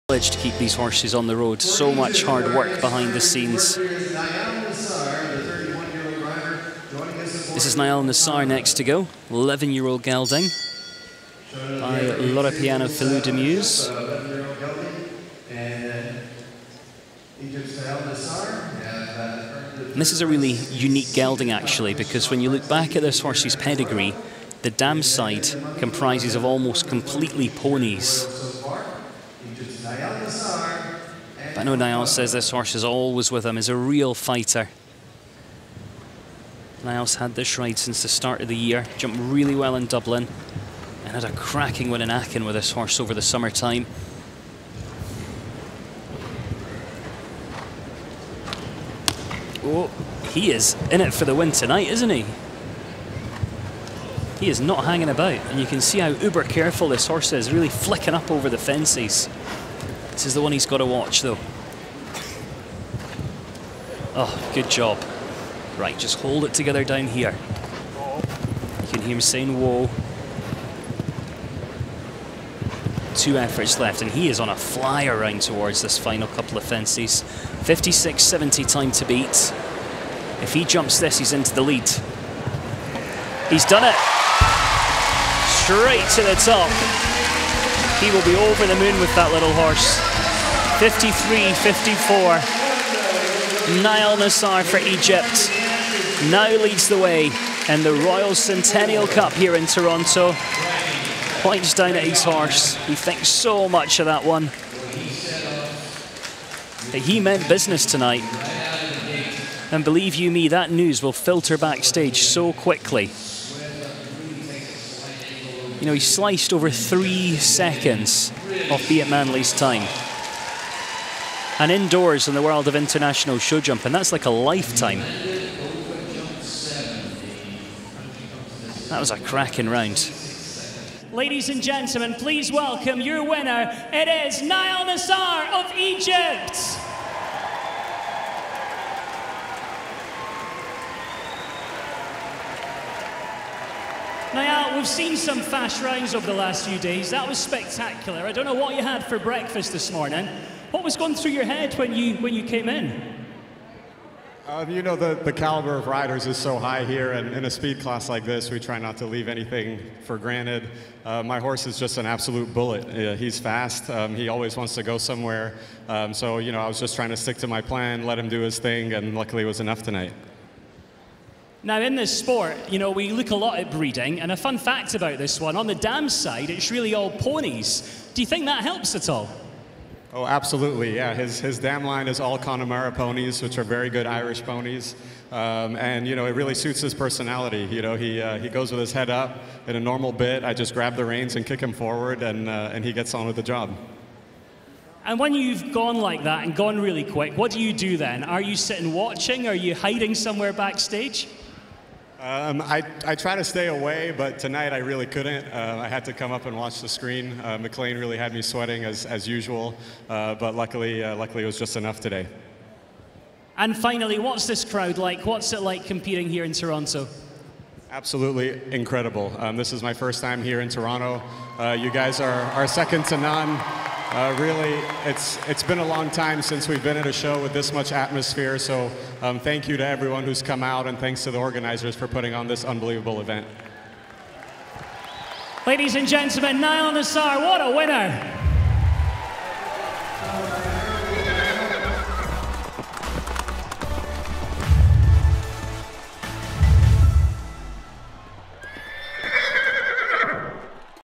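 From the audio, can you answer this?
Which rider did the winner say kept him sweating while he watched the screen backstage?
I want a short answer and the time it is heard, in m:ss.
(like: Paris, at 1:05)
McLain, at 3:27.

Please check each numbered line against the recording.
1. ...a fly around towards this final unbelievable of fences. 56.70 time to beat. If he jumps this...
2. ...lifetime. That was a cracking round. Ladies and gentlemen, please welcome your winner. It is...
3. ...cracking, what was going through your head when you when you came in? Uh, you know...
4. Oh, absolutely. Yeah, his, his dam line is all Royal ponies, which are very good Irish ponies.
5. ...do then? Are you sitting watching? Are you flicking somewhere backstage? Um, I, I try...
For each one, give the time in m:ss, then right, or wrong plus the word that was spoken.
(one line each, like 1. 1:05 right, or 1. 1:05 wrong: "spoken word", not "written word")
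1. 1:14 wrong: "couple", not "unbelievable"
2. 2:04 right
3. 2:29 wrong: "morning", not "cracking"
4. 3:00 wrong: "Connemara", not "Royal"
5. 3:17 wrong: "hiding", not "flicking".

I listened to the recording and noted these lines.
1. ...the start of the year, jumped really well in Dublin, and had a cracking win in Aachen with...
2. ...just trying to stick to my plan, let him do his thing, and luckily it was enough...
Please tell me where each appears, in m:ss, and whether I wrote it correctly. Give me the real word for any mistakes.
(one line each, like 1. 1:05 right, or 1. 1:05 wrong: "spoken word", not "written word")
1. 0:38 right
2. 2:46 right.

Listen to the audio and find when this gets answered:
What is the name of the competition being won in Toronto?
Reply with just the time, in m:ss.
1:38.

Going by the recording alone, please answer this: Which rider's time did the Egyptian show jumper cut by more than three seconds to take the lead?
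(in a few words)
Beat Mändli.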